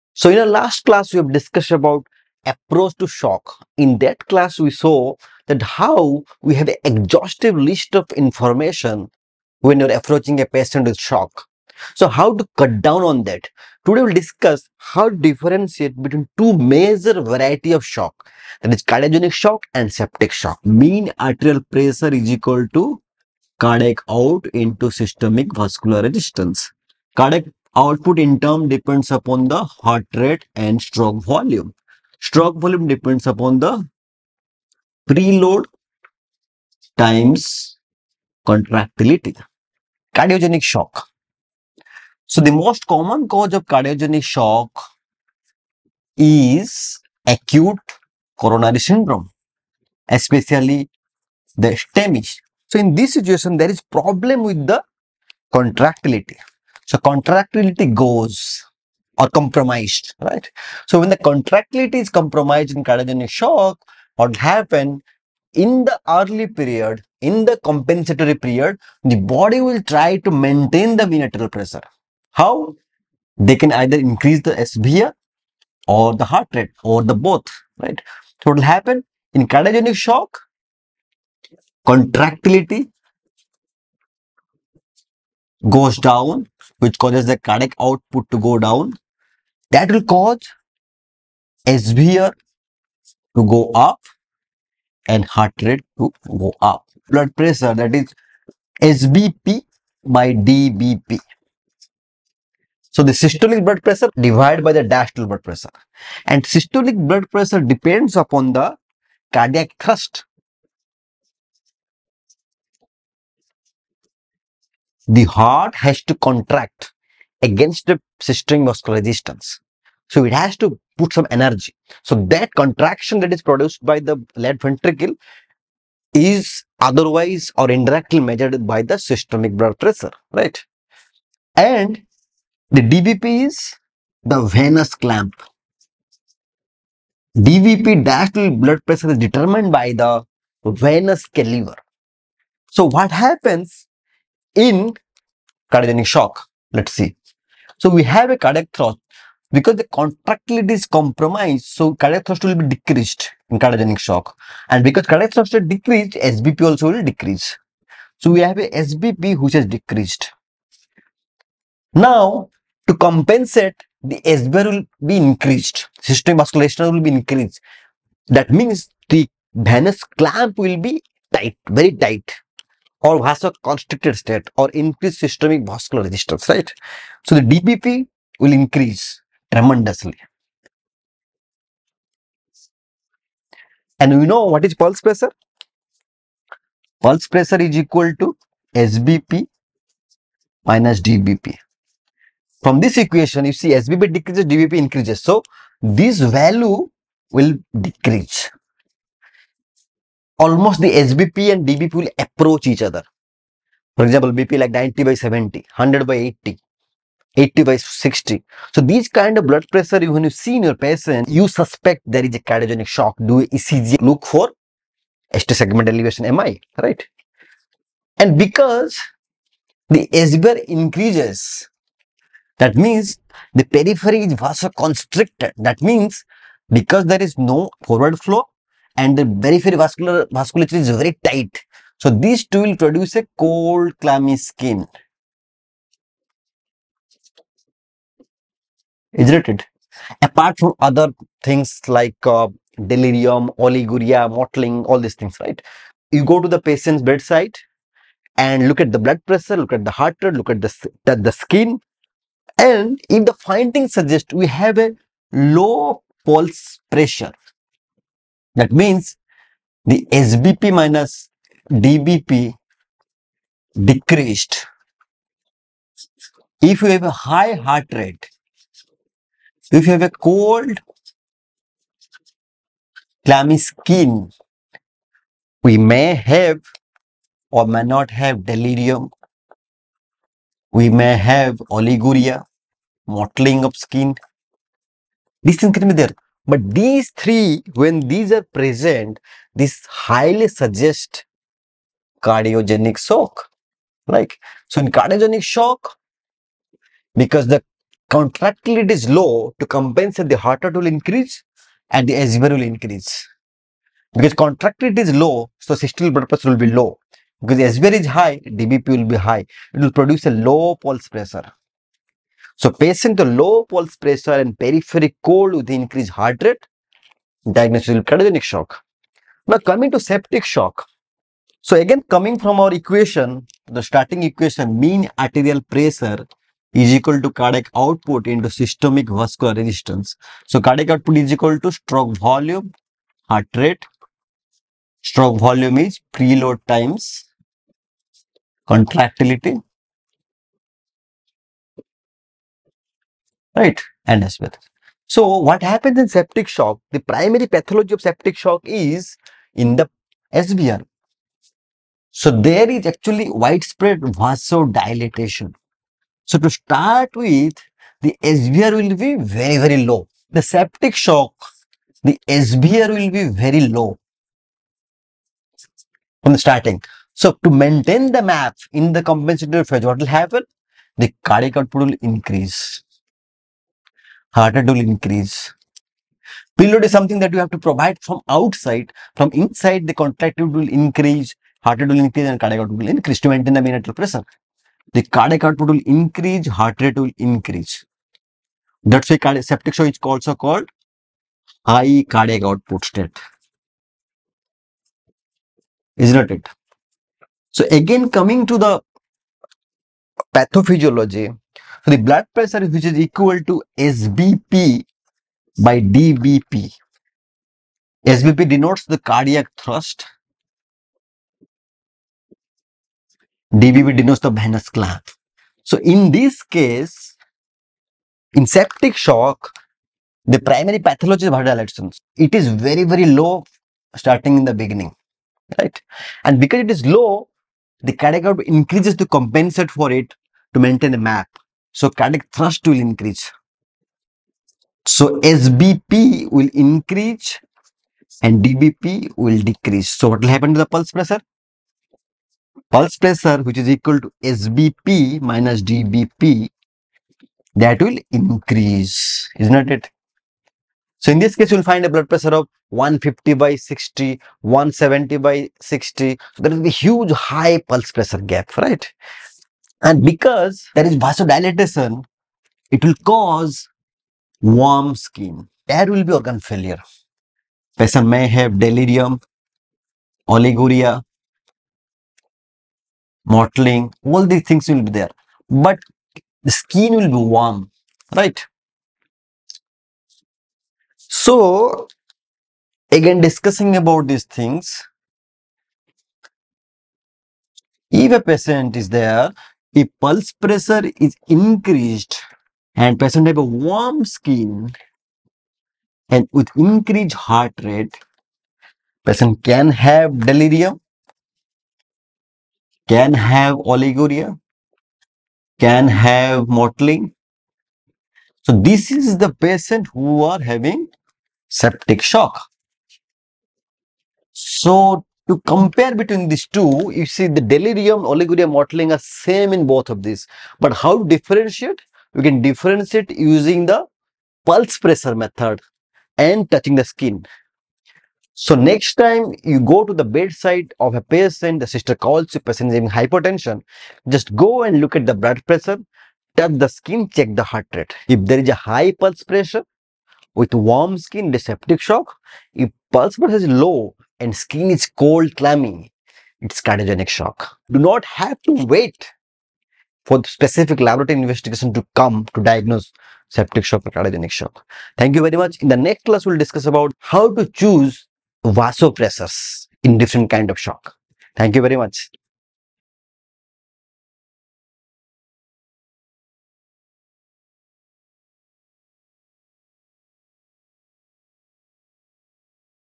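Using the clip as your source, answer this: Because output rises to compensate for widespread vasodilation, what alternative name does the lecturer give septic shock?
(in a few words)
High cardiac output state.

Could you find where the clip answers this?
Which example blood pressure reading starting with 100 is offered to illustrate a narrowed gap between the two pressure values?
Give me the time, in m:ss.
3:25.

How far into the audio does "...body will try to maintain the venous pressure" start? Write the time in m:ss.
1:09.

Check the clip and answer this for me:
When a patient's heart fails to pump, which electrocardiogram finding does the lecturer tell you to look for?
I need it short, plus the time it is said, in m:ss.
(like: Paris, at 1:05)
ST segment elevation MI, at 3:35.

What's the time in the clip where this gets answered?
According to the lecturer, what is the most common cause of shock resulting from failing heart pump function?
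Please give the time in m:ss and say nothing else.
0:47.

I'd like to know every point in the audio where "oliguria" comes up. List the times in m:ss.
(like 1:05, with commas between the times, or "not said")
4:03, 4:41, 7:50, 8:23, 8:38.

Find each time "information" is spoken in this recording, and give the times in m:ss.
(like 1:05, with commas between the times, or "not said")
0:08.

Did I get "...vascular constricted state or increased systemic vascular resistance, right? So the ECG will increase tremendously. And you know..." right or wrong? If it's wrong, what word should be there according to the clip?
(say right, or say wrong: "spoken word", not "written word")
wrong: "DBP", not "ECG".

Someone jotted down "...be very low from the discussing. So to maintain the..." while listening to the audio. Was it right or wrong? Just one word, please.
wrong.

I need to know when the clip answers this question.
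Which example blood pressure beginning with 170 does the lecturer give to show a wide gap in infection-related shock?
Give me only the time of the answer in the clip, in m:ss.
7:34.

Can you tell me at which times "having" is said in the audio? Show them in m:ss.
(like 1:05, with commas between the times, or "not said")
8:30, 8:52.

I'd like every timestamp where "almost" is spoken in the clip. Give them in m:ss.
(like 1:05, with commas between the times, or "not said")
3:20.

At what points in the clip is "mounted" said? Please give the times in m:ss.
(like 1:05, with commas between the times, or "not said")
not said.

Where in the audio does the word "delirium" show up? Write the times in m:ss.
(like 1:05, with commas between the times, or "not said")
4:02, 4:38, 7:48, 8:20, 8:37.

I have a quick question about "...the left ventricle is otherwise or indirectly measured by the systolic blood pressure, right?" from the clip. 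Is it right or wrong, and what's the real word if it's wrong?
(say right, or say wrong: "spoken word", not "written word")
right.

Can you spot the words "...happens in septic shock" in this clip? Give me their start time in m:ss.
5:45.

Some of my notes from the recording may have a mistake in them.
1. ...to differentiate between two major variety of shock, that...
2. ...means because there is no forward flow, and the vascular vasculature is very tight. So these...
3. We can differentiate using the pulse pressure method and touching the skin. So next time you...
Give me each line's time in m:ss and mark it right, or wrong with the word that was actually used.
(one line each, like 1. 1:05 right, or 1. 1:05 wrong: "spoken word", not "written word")
1. 0:15 right
2. 3:45 right
3. 8:42 right.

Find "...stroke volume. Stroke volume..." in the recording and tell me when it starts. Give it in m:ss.
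0:30.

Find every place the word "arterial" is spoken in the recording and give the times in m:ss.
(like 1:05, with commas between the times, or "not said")
0:21, 5:25, 6:23.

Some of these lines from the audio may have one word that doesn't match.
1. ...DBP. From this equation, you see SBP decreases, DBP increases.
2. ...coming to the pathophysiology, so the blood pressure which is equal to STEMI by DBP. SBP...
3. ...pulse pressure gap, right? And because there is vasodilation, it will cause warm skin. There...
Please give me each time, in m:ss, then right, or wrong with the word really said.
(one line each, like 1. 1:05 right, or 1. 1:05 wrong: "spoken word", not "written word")
1. 3:11 right
2. 6:38 wrong: "SBP", not "STEMI"
3. 7:37 right.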